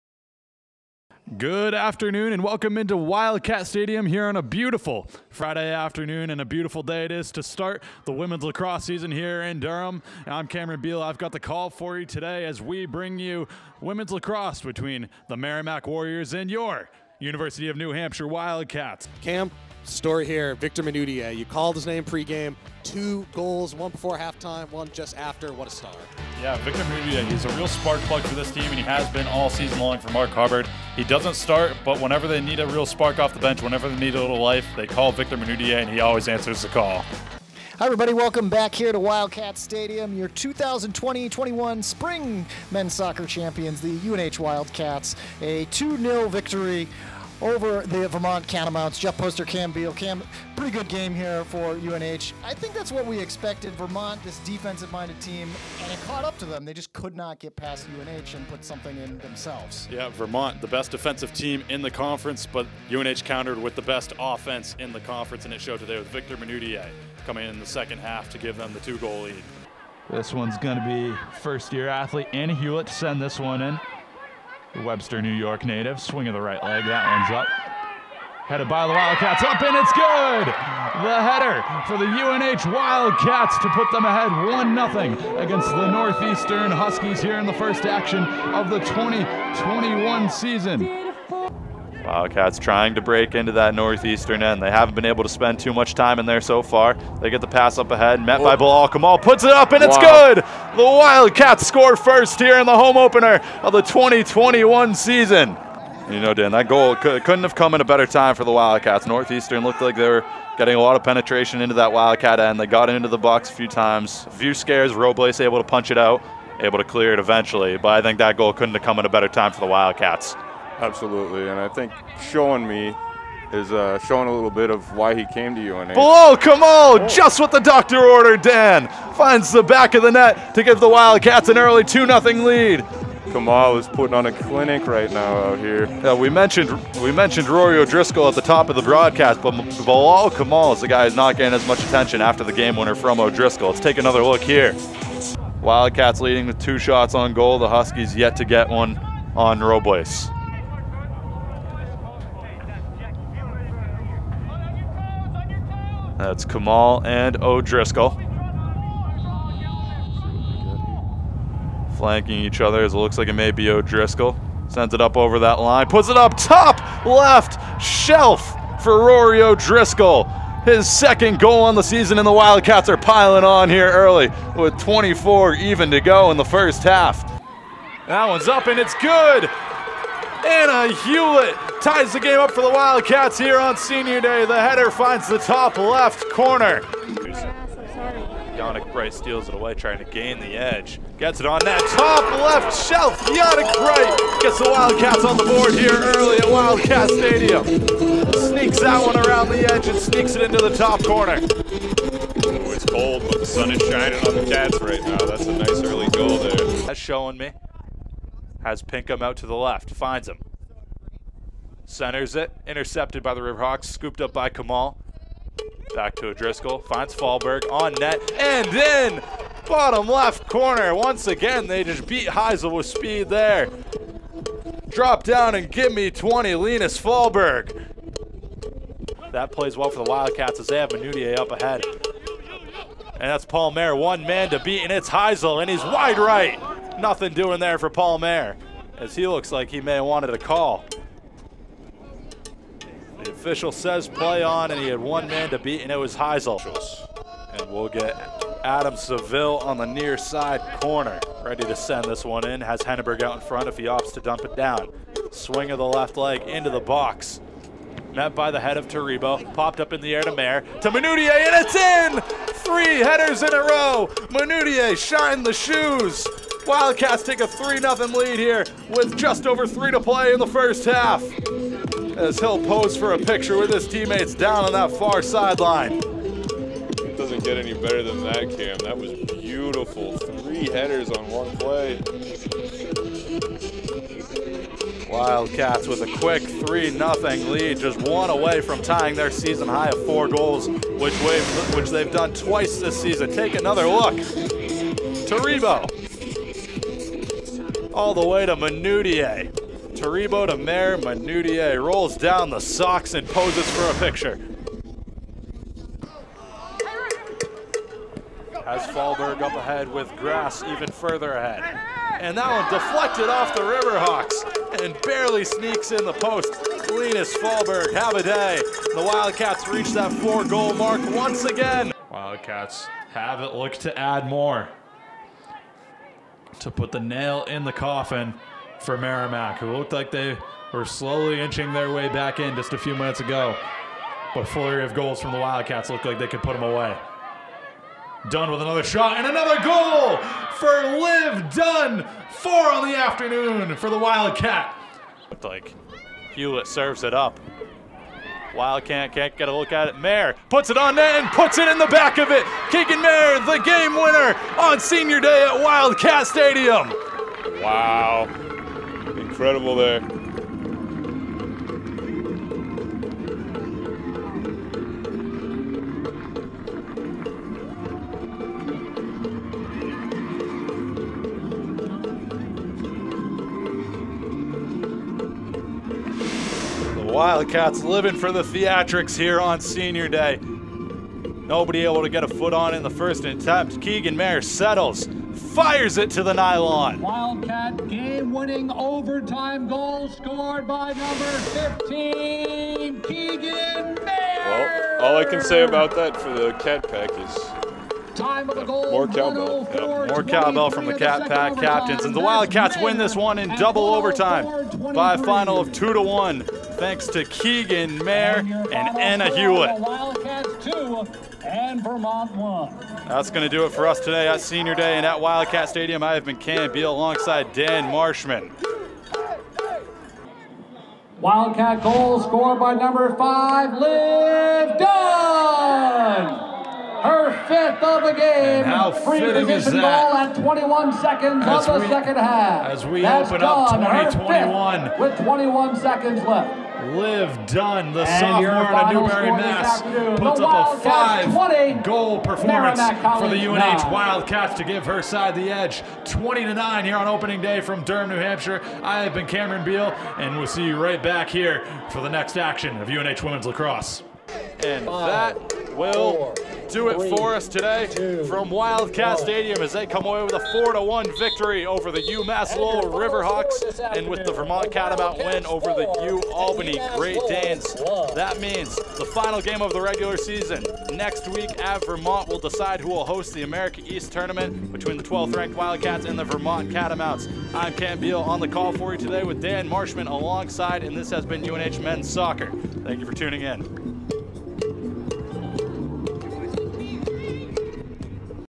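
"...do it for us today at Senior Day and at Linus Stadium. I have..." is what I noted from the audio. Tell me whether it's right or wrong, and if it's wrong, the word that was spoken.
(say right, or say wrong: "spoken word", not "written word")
wrong: "Wildcat", not "Linus".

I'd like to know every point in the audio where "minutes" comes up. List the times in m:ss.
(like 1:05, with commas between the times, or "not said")
5:32.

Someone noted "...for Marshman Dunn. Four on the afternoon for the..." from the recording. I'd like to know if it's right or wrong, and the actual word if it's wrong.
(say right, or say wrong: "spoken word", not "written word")
wrong: "Liv", not "Marshman".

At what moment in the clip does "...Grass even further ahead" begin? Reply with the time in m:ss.
5:10.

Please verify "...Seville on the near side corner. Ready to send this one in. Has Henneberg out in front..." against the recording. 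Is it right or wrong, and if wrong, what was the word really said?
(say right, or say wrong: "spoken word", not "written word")
right.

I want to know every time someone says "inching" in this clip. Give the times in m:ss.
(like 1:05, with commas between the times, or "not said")
5:31.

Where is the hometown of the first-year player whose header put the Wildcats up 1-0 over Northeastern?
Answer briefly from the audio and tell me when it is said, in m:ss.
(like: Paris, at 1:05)
Webster, New York, at 1:14.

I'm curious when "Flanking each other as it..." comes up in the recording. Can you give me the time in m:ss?
2:41.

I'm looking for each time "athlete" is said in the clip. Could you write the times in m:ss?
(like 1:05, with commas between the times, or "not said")
1:11.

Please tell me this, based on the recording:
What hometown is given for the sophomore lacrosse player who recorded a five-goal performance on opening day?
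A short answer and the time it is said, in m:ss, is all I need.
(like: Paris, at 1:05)
Newbury, Mass, at 7:19.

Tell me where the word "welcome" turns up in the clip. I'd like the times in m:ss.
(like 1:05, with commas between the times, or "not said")
0:02, 0:38.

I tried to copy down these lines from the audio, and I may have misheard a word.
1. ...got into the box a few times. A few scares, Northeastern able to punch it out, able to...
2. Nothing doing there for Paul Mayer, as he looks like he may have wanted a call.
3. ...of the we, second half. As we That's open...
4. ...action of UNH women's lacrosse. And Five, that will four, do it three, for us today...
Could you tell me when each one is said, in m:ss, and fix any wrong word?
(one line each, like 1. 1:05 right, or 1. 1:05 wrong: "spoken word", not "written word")
1. 1:52 wrong: "Robles", not "Northeastern"
2. 3:57 right
3. 7:11 right
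4. 7:32 right.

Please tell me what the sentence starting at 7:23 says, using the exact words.
Wildcats to give her side the edge, 20 to nine here on opening day from Durham, New Hampshire.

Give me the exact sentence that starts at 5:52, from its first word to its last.
Keegan Mayer, the game winner on senior day at Wildcat Stadium.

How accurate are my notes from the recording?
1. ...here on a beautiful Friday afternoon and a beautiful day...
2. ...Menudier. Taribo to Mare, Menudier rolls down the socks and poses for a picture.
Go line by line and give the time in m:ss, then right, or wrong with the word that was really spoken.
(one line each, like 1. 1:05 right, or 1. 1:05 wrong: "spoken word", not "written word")
1. 0:04 right
2. 4:58 right.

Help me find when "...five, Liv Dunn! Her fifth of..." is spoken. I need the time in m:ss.
7:03.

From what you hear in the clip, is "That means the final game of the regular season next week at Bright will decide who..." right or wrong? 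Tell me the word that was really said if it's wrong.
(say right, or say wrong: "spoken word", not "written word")
wrong: "Vermont", not "Bright".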